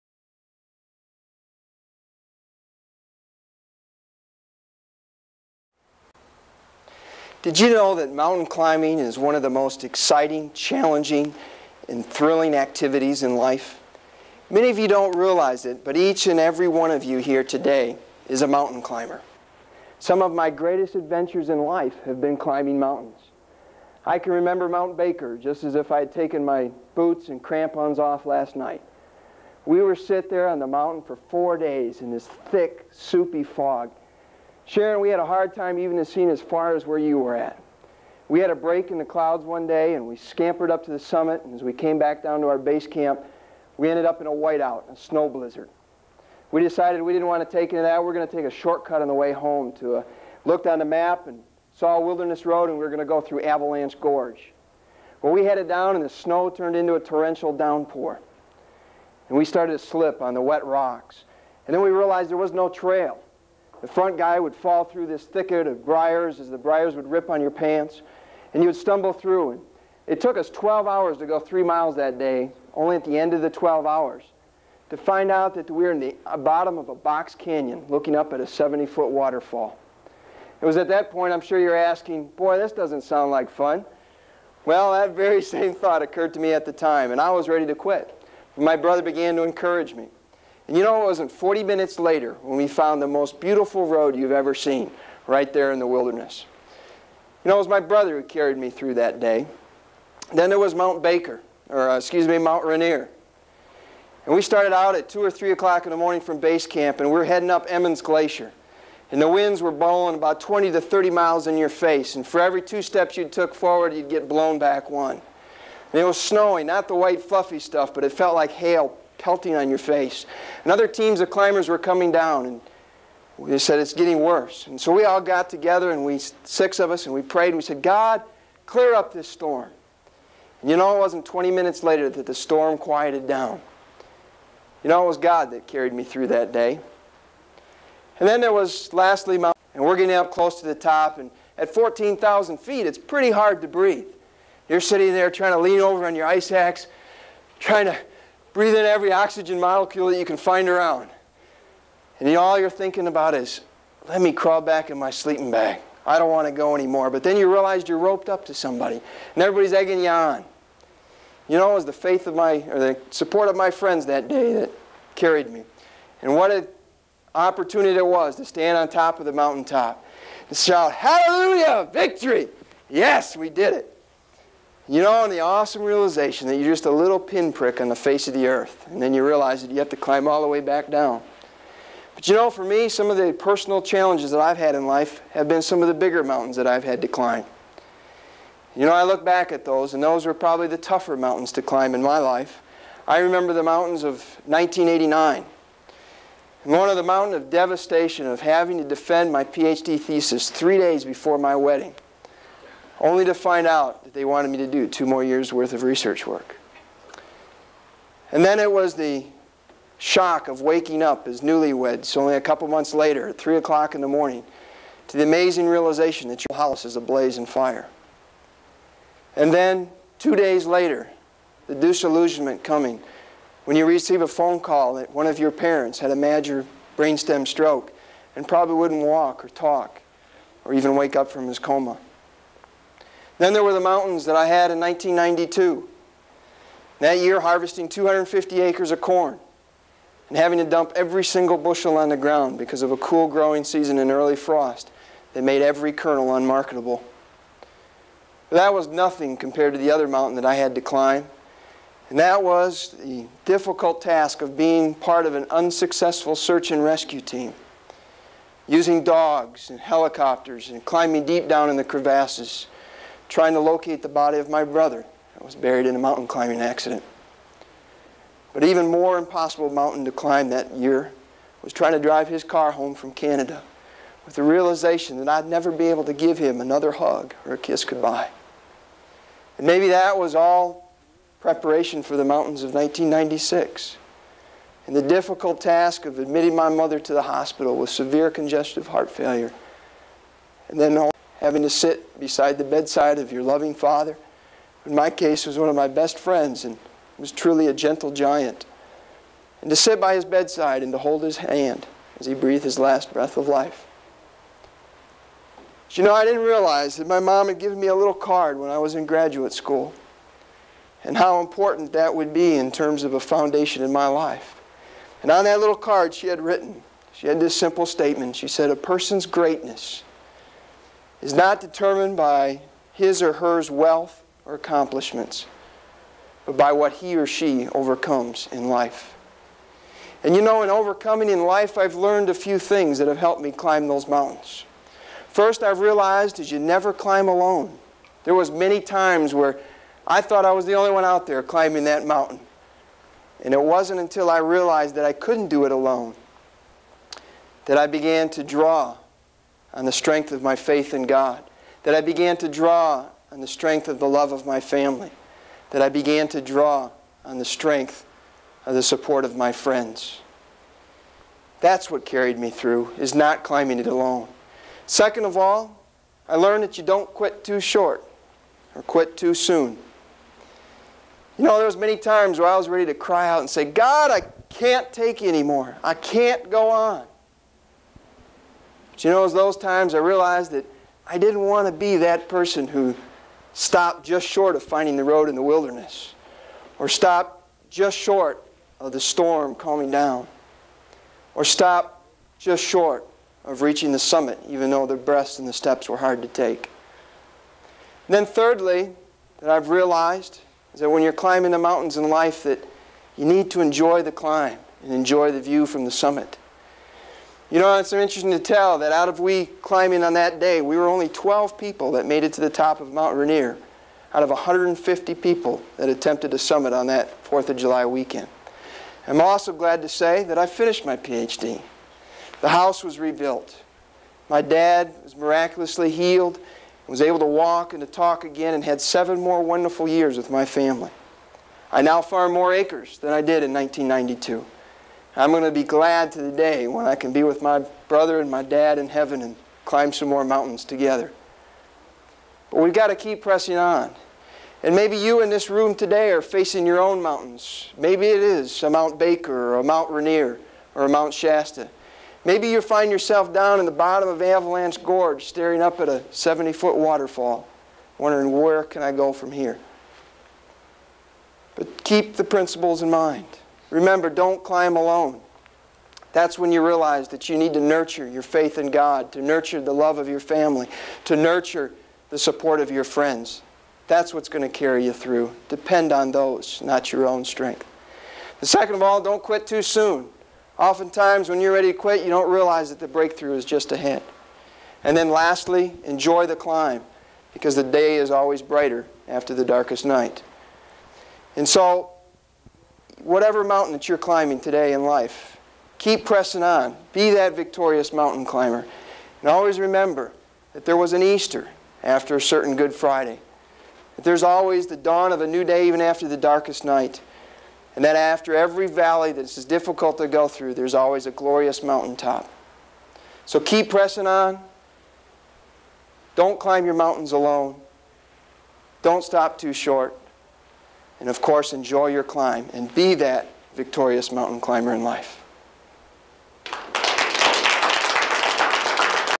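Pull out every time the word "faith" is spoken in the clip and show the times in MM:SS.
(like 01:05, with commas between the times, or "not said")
02:41, 05:50, 07:48.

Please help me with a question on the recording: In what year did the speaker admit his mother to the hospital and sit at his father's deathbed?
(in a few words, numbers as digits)
1996.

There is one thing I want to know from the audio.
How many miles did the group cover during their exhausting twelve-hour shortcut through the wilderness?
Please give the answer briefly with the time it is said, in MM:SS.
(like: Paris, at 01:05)
3, at 01:11.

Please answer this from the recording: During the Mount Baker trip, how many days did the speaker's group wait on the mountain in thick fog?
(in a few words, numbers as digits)
4.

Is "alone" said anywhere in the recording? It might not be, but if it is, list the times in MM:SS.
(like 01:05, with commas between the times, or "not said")
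05:37, 05:45, 06:03, 07:44, 08:37.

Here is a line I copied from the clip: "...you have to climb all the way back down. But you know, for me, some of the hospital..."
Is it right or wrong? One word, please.
wrong.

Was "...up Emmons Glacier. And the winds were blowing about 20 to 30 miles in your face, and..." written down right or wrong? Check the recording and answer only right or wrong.
right.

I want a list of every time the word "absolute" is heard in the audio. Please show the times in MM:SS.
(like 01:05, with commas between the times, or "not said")
not said.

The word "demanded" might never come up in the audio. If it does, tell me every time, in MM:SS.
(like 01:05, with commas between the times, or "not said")
not said.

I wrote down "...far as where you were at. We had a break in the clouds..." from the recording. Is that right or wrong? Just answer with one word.
right.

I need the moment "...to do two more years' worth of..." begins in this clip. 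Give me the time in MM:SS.
03:24.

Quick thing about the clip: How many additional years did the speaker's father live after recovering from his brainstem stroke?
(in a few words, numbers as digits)
7.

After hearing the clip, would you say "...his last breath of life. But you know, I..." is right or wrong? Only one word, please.
right.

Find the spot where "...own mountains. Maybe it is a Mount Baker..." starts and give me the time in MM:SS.
07:26.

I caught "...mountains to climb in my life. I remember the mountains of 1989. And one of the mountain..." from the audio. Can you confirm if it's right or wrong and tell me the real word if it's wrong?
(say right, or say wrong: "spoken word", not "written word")
right.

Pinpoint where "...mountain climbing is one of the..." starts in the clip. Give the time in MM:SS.
00:08.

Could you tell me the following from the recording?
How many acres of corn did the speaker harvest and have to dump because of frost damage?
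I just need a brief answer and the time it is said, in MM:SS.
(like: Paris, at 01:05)
250, at 03:57.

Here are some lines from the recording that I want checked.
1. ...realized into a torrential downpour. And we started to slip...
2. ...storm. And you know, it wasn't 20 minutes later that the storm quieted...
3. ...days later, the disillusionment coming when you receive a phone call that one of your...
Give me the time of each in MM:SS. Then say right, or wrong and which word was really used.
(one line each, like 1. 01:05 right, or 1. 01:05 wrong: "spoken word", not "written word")
1. 00:56 wrong: "turned", not "realized"
2. 02:09 right
3. 03:40 right.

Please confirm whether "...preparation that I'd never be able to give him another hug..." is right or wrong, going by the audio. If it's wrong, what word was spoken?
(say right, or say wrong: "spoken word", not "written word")
wrong: "realization", not "preparation".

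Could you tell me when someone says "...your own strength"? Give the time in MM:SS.
07:56.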